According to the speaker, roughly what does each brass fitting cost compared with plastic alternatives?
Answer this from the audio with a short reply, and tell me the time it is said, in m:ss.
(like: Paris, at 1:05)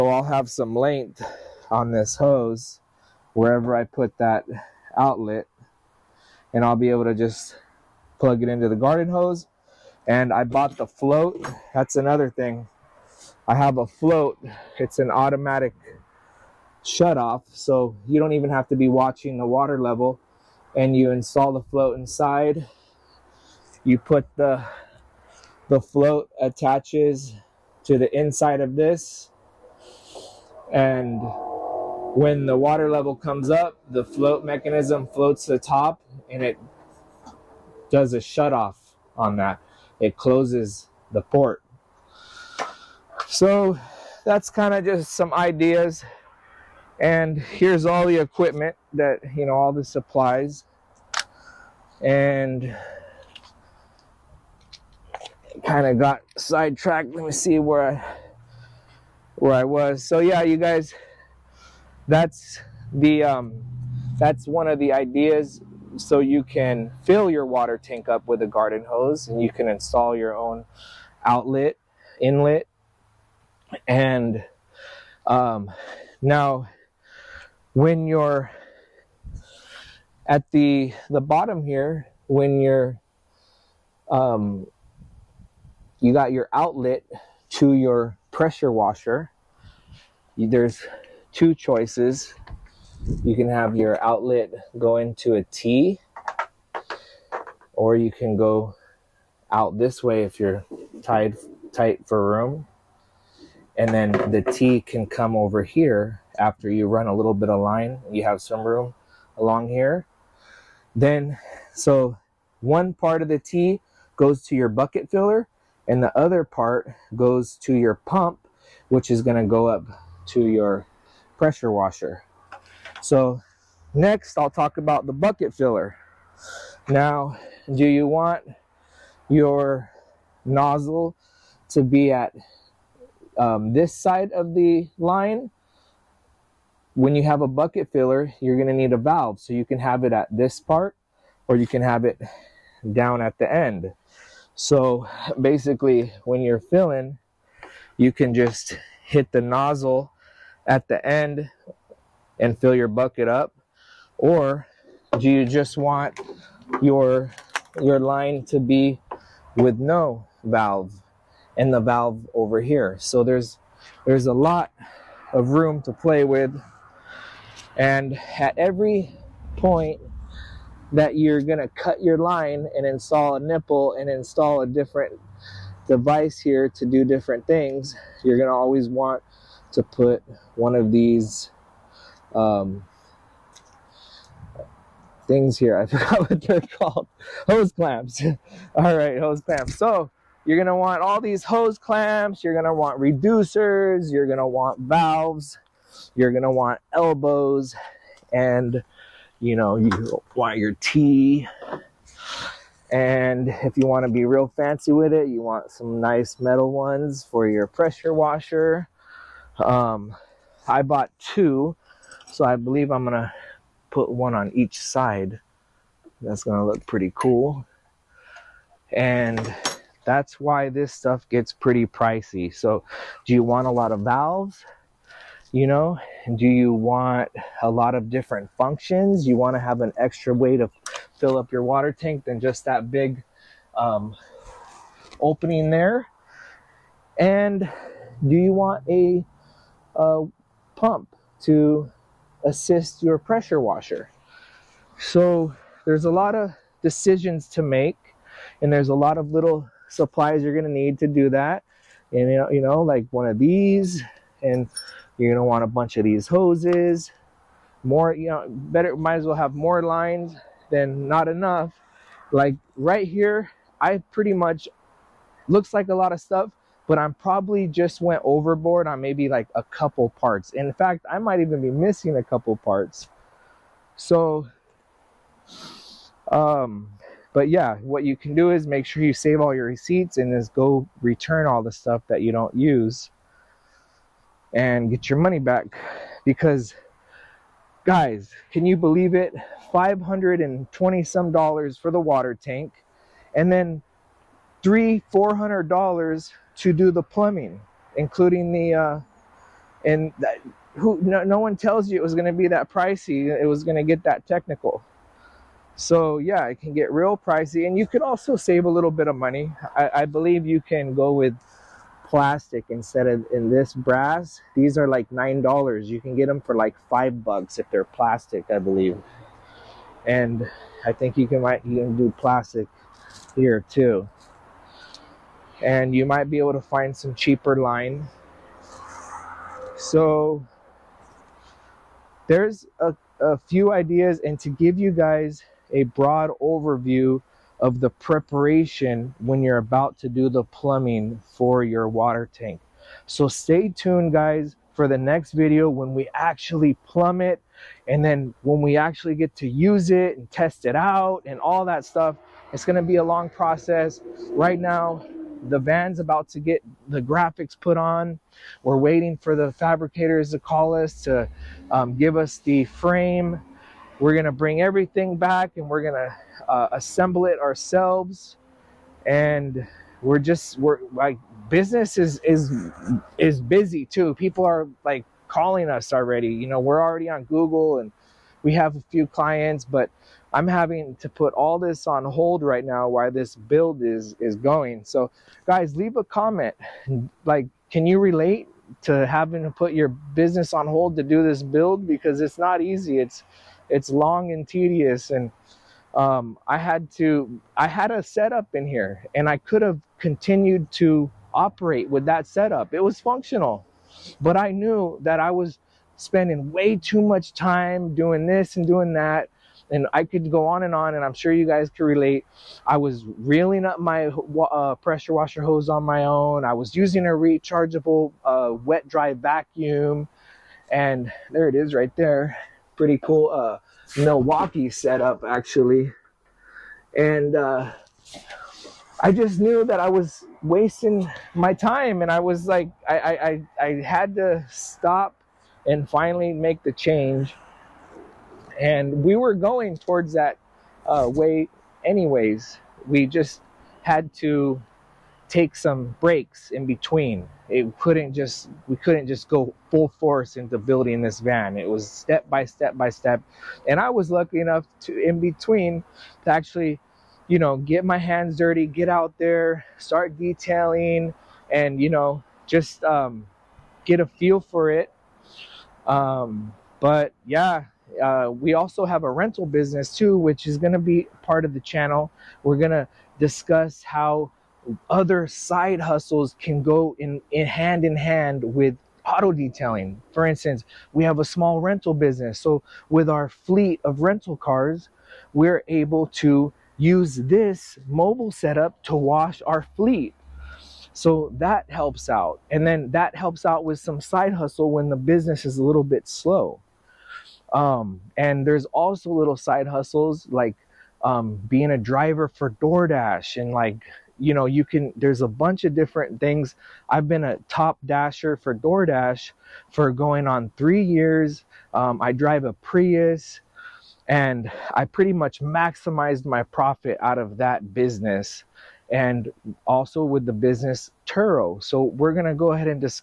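$9, at 5:15.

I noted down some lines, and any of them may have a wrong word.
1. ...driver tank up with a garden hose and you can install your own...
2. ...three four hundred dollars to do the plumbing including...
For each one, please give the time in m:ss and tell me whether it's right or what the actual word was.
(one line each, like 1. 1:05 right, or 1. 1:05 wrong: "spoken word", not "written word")
1. 1:07 wrong: "water", not "driver"
2. 4:54 right.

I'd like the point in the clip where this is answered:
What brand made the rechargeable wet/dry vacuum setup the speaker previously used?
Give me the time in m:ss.
7:03.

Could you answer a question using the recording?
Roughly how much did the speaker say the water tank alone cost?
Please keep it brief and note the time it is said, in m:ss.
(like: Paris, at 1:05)
$520, at 4:49.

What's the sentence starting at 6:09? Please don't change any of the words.
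And we're just, we're like, business is, is, is busy too.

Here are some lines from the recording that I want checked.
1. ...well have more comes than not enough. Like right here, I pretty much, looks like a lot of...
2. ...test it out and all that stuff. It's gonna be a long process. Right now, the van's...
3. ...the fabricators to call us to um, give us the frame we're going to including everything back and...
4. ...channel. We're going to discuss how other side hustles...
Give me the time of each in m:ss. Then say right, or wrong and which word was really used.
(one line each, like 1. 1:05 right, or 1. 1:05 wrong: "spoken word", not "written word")
1. 4:19 wrong: "lines", not "comes"
2. 5:50 right
3. 5:59 wrong: "bring", not "including"
4. 7:51 right.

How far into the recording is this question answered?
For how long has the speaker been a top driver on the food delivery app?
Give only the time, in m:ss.
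8:30.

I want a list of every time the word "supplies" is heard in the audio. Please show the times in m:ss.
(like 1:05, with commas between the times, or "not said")
0:49, 4:09.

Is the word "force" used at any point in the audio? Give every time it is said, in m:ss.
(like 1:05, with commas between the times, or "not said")
7:29.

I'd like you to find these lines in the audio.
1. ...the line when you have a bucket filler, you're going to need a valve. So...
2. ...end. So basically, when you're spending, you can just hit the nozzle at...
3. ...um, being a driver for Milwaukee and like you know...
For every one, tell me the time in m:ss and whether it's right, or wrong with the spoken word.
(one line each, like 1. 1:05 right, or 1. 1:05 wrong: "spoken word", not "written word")
1. 2:14 right
2. 2:23 wrong: "filling", not "spending"
3. 8:21 wrong: "DoorDash", not "Milwaukee".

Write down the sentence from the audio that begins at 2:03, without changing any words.
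So next I'll talk about the bucket filler.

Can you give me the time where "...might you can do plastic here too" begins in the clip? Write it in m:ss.
5:21.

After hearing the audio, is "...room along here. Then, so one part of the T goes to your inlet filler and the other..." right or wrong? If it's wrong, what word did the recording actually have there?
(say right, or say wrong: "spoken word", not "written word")
wrong: "bucket", not "inlet".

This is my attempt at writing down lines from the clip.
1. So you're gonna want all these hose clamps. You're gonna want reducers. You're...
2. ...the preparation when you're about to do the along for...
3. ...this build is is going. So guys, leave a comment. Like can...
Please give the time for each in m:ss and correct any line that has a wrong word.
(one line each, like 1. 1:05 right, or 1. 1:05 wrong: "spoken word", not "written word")
1. 3:09 right
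2. 5:37 wrong: "plumbing", not "along"
3. 6:23 right.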